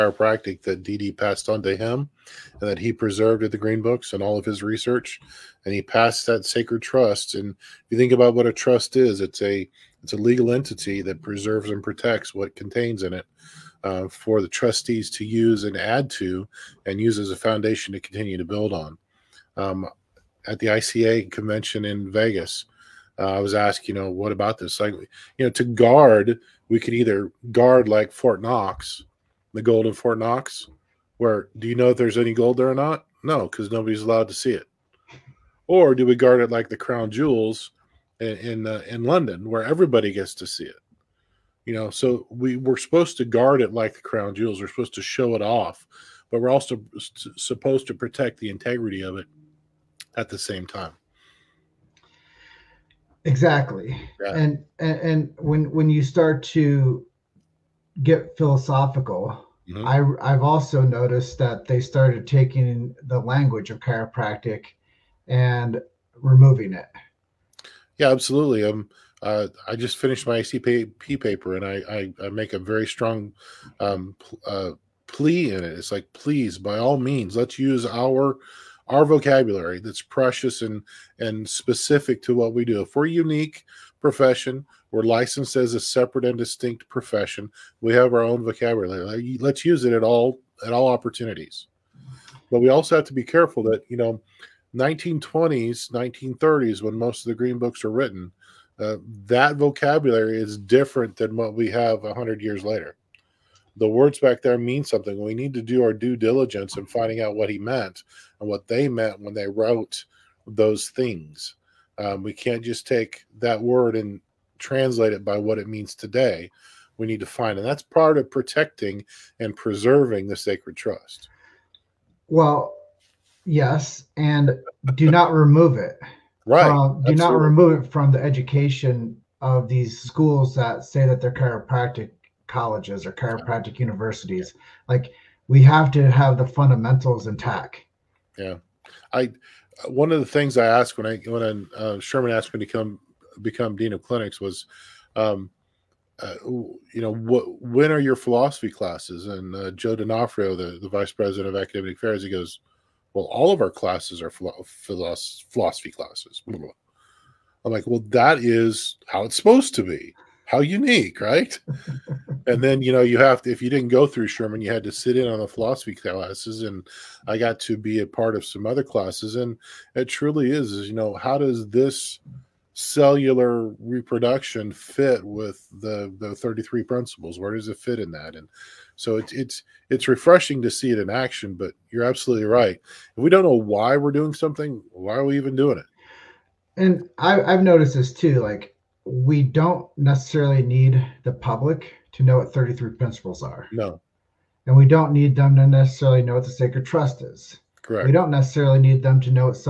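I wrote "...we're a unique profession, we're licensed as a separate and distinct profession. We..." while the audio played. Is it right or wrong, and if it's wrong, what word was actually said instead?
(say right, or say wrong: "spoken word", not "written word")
right.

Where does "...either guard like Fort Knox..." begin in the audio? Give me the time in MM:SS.
00:26.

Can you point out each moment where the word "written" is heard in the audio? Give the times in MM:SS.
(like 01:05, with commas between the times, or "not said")
01:37.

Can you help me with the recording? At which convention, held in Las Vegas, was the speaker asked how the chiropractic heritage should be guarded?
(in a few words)
ICA convention.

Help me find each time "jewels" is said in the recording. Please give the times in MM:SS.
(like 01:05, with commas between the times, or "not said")
00:37, 00:44.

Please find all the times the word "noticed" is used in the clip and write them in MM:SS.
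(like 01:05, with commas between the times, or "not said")
01:00, 03:07.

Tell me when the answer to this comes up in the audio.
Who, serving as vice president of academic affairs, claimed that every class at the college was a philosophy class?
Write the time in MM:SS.
02:29.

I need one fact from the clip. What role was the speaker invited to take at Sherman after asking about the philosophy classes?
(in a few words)
Dean of clinics.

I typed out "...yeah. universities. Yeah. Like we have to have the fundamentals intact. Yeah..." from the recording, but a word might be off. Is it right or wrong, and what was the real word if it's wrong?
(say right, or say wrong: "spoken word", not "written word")
right.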